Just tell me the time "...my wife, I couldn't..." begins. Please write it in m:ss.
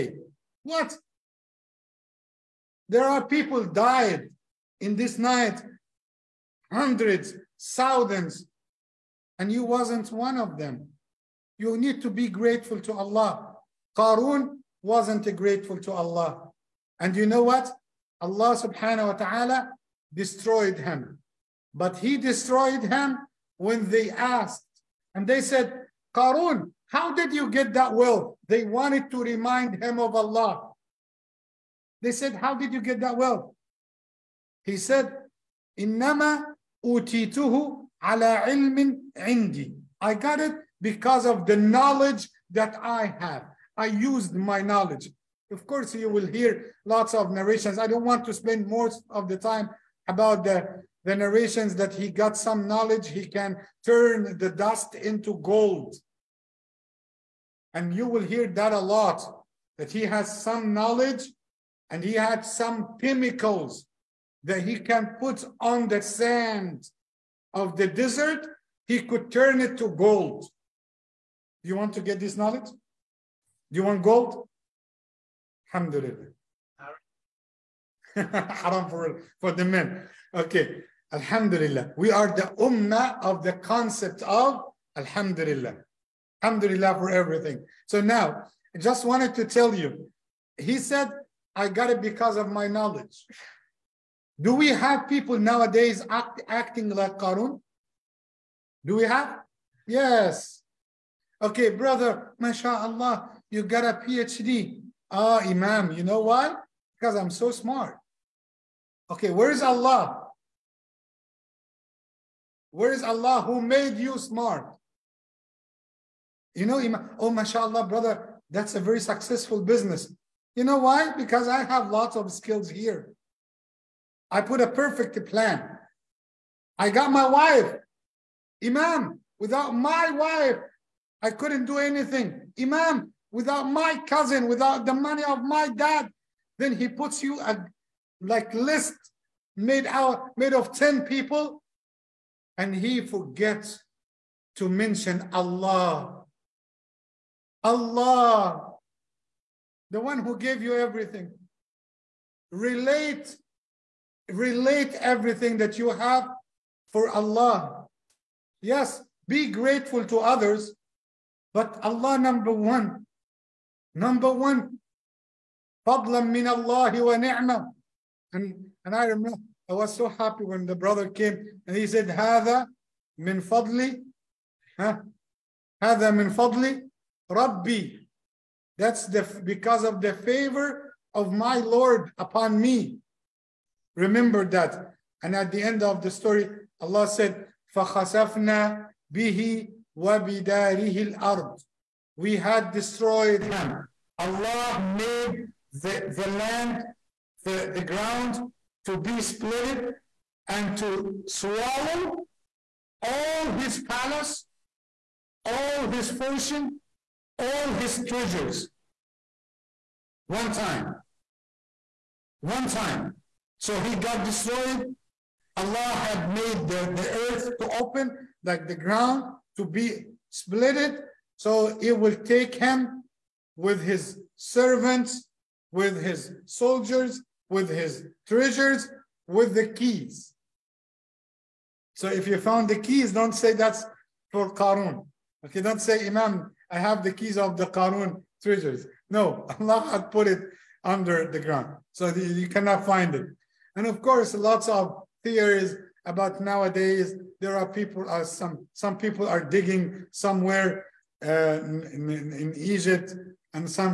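2:09.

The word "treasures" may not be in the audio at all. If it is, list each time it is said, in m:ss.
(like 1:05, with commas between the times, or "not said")
3:28, 3:48, 3:58.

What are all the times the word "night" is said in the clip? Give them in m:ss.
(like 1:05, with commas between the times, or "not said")
0:05.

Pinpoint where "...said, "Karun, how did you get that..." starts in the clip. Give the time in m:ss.
0:25.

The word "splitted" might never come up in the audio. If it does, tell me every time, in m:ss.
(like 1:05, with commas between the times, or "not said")
3:19, 3:40.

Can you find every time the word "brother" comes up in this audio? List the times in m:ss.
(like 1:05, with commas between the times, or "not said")
1:41, 1:57, 2:50.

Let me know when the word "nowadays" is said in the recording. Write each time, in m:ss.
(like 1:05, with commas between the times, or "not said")
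1:35, 4:06.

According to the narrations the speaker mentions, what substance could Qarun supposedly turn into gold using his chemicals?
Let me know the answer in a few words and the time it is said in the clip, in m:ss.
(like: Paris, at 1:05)
Sand of the desert, at 1:06.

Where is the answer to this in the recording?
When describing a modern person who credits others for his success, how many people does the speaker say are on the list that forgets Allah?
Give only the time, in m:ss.
2:20.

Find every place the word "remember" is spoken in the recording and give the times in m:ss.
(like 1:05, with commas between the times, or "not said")
2:49, 3:03.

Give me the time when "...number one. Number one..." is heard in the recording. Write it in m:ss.
2:42.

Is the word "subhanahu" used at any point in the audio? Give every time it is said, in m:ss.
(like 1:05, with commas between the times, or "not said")
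0:18.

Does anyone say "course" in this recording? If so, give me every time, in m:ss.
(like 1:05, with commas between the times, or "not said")
0:45, 4:04.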